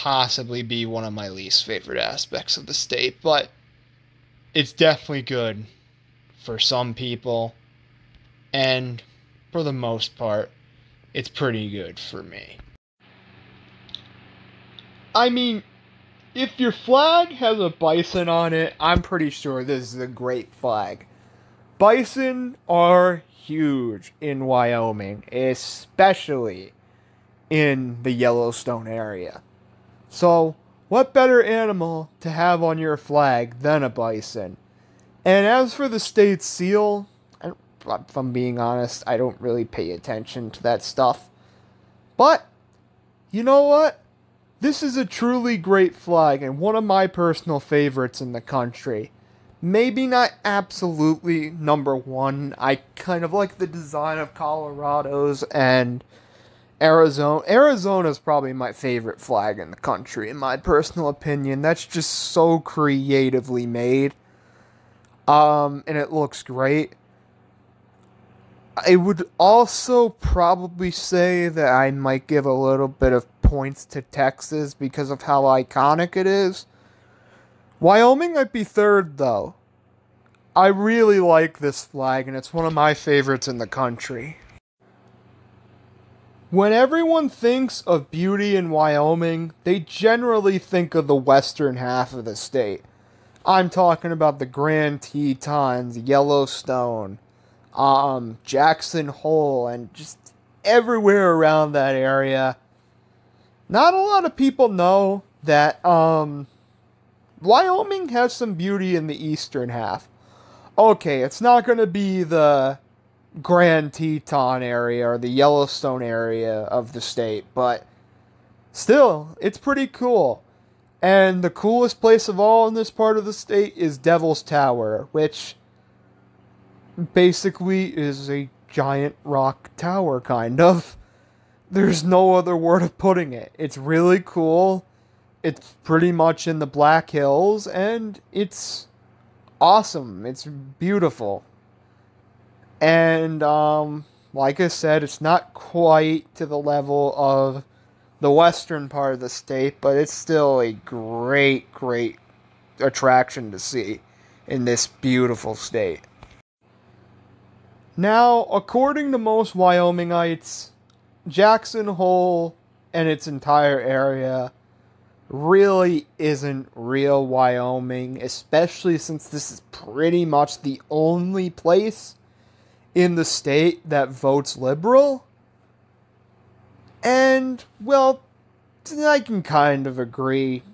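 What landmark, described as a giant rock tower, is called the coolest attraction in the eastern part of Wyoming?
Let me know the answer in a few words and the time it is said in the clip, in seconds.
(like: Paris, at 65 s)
Devil's Tower, at 123 s.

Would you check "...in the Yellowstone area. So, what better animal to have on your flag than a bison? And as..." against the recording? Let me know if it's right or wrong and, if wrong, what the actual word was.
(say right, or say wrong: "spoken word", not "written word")
right.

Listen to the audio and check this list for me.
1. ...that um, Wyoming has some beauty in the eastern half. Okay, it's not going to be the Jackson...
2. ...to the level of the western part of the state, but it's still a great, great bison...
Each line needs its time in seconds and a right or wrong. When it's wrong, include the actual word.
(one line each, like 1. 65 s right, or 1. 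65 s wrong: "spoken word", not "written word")
1. 105 s wrong: "Grand", not "Jackson"
2. 146 s wrong: "attraction", not "bison".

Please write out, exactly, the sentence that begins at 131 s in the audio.
There's no other word of putting it.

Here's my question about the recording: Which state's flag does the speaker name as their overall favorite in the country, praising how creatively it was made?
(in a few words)
Arizona.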